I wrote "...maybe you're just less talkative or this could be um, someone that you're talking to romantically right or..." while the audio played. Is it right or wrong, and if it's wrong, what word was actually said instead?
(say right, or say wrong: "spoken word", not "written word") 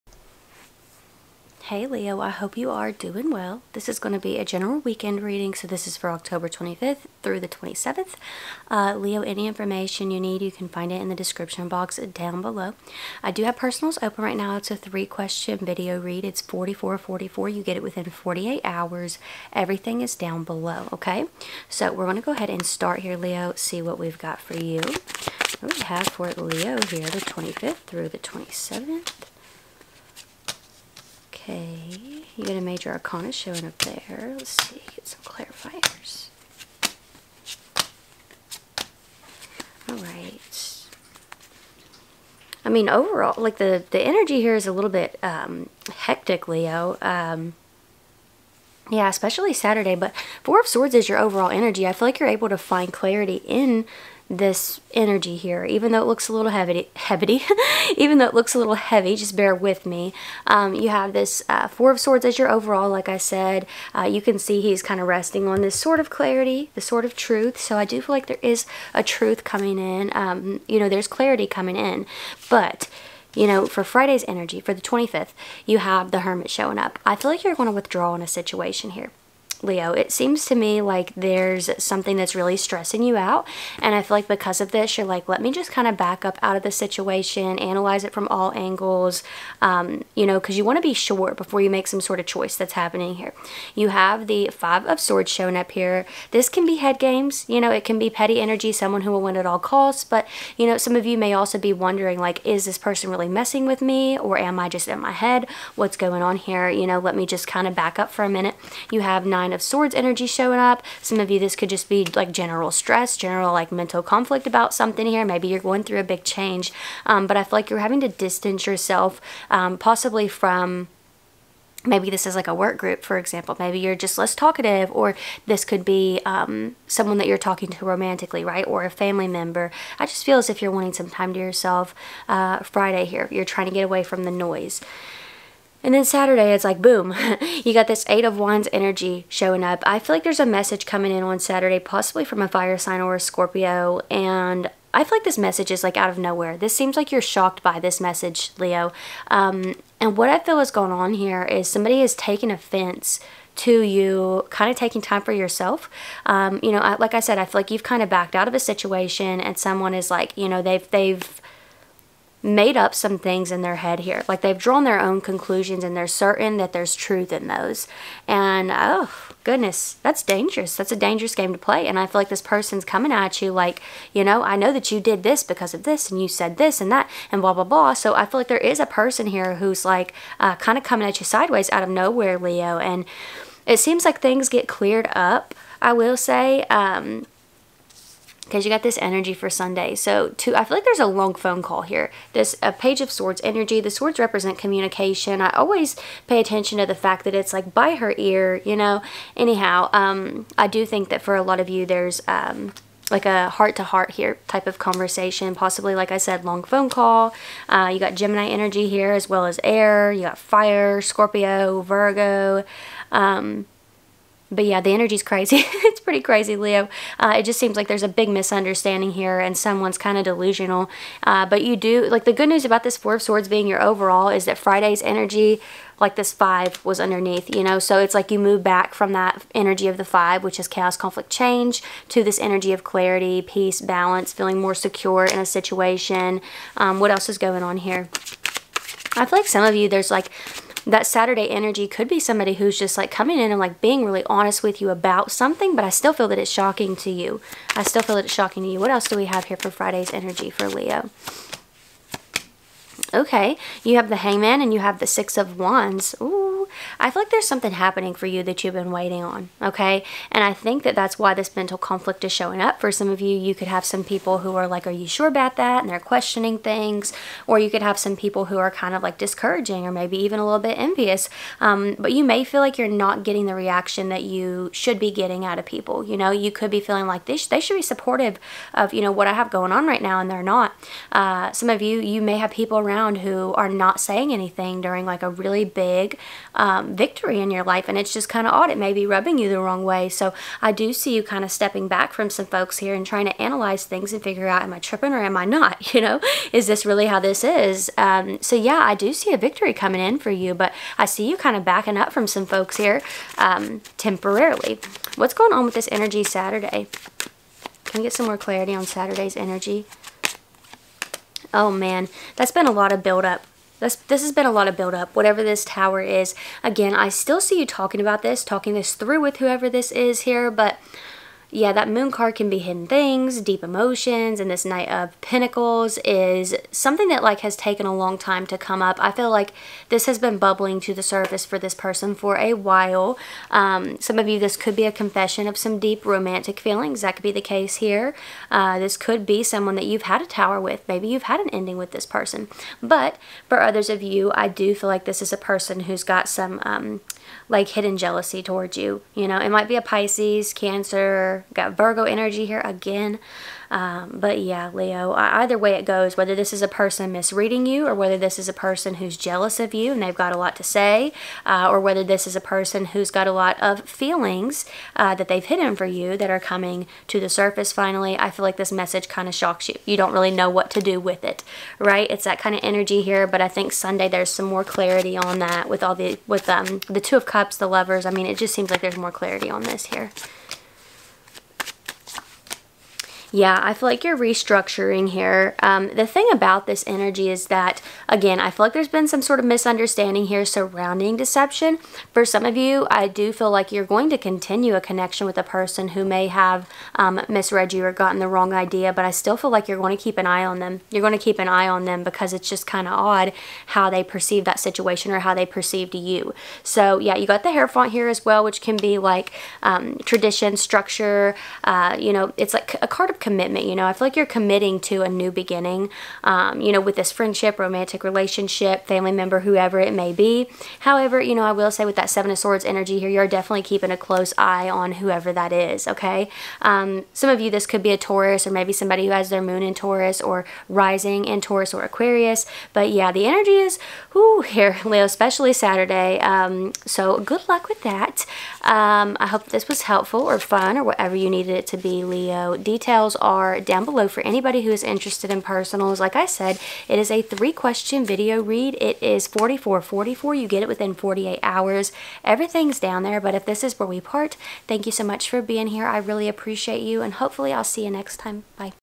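right.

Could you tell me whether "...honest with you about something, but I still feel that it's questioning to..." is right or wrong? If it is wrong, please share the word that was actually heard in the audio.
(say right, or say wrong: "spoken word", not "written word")
wrong: "shocking", not "questioning".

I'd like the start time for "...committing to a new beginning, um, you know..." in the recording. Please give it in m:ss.
6:54.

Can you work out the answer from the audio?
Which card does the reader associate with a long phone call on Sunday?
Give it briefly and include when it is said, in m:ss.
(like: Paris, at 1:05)
Page of Swords, at 3:12.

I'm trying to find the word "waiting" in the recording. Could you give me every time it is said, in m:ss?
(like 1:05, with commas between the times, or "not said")
4:18.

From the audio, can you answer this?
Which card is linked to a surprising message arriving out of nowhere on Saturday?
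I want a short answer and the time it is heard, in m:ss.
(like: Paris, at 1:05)
Eight of Wands, at 2:18.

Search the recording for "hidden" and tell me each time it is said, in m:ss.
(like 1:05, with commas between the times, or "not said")
5:22, 5:47, 6:05.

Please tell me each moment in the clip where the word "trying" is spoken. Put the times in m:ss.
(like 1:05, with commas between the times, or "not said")
2:13, 4:53.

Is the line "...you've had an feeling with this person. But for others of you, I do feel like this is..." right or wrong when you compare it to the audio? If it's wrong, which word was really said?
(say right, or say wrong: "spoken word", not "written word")
wrong: "ending", not "feeling".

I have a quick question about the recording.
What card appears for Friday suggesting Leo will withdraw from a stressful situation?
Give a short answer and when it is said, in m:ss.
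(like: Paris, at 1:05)
The Hermit, at 1:16.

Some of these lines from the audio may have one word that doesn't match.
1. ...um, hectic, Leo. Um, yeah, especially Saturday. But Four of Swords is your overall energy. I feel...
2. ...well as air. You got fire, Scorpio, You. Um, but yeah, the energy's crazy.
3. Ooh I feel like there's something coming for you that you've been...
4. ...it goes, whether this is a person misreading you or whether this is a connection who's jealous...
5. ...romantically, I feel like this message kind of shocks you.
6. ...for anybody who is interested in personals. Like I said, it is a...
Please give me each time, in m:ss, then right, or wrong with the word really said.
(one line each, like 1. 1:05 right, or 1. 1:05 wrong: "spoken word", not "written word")
1. 0:45 right
2. 3:29 wrong: "Virgo", not "You"
3. 4:16 wrong: "happening", not "coming"
4. 5:55 wrong: "person", not "connection"
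5. 6:07 wrong: "finally", not "romantically"
6. 7:24 right.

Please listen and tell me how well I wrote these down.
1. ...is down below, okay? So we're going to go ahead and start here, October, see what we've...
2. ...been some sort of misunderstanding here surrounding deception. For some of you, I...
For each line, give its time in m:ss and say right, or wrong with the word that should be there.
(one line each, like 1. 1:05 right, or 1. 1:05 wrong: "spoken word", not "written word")
1. 0:20 wrong: "Leo", not "October"
2. 6:28 right.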